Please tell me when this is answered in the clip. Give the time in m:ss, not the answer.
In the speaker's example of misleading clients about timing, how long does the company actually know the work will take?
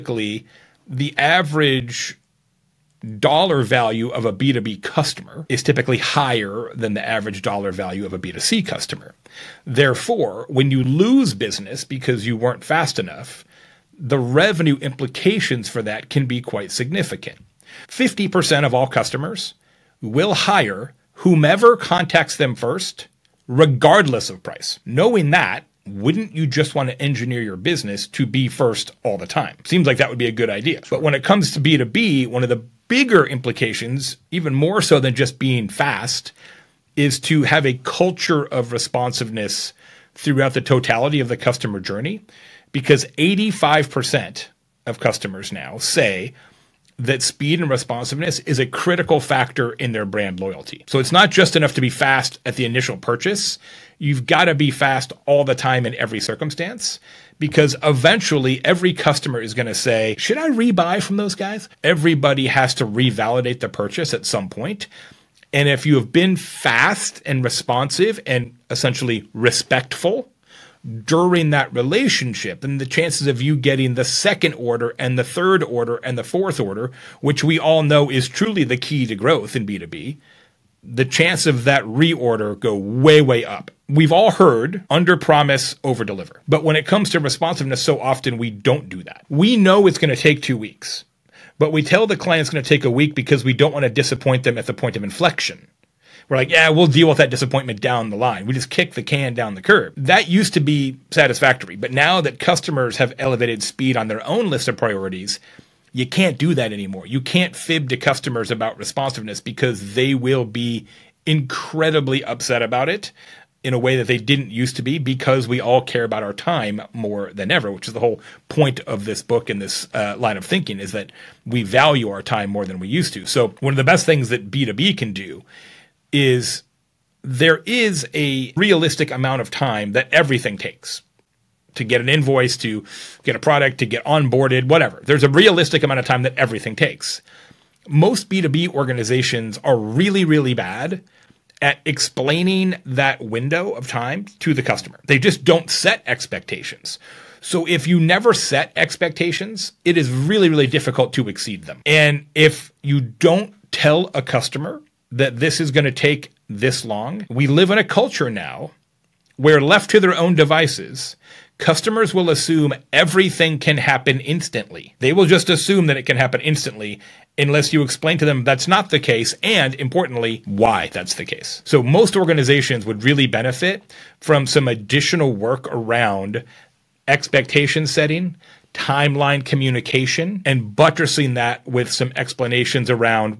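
1:30.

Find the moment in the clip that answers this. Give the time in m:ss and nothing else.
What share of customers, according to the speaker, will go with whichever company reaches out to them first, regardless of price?
0:17.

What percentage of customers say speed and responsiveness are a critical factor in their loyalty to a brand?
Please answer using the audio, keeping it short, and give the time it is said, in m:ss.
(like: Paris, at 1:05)
85%, at 0:43.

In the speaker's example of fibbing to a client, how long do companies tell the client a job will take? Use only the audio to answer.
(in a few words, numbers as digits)
a week.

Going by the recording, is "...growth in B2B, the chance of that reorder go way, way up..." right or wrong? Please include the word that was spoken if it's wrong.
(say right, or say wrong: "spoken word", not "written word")
right.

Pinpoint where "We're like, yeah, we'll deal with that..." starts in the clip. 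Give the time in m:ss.
1:36.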